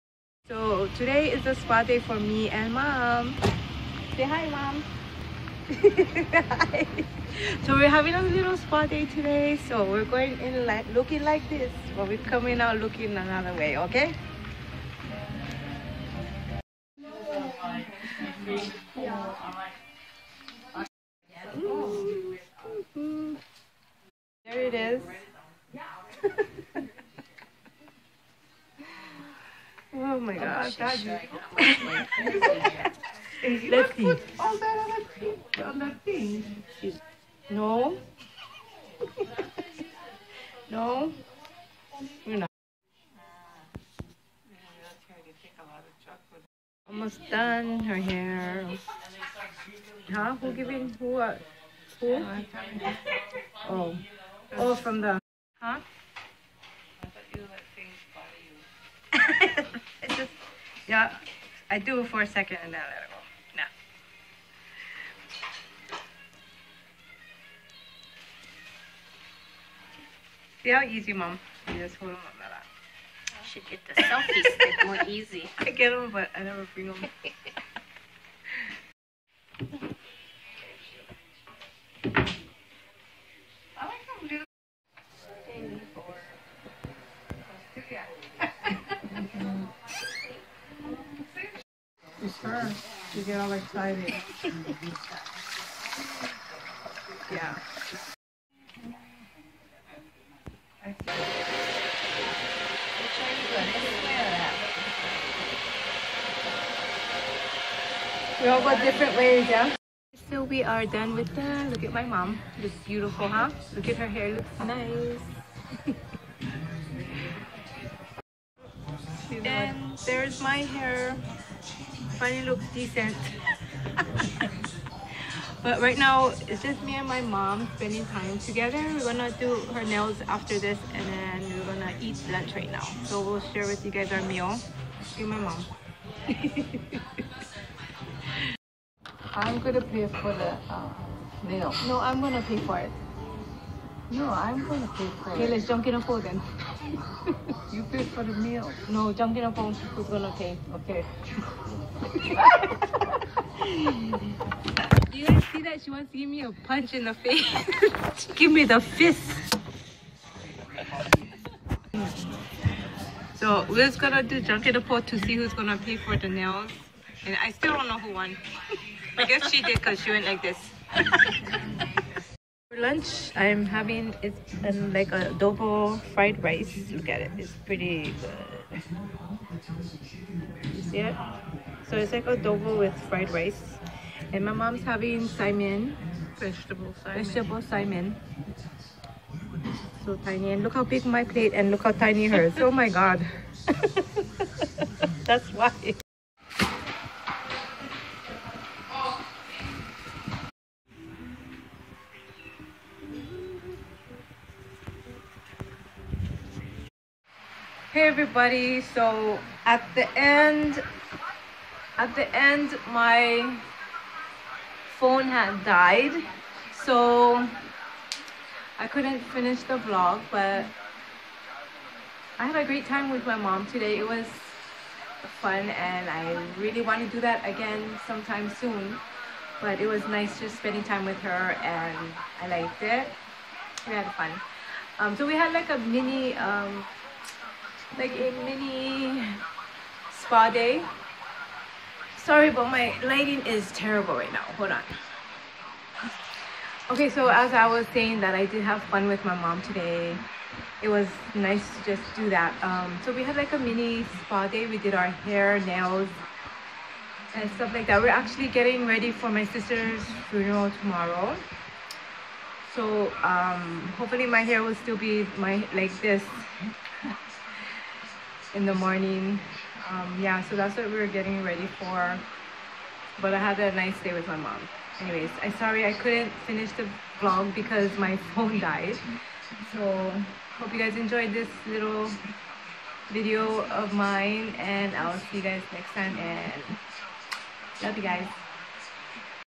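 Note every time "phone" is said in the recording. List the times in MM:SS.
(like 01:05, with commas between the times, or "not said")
02:29, 03:34, 04:38.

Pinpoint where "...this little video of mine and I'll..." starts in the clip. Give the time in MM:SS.
04:41.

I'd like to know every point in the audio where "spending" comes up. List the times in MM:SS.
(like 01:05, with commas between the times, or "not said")
02:07, 03:50.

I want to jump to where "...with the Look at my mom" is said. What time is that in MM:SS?
01:51.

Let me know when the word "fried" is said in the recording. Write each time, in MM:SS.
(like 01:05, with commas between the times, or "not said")
02:56, 03:03.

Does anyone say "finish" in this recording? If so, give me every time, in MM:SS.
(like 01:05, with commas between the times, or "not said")
03:39, 04:36.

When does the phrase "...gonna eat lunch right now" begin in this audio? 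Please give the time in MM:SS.
02:11.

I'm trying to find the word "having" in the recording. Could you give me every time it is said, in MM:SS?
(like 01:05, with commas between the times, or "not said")
00:07, 02:53, 03:04.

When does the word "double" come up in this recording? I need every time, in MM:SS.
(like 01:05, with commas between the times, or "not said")
02:55, 03:02.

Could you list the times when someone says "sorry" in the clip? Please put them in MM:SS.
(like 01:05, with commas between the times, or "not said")
04:02, 04:35.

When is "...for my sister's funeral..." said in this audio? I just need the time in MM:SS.
04:19.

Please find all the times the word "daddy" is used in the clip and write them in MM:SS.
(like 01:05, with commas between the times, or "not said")
00:30.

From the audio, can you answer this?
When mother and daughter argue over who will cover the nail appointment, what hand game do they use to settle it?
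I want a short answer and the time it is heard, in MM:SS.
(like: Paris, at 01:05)
jan ken po, at 02:44.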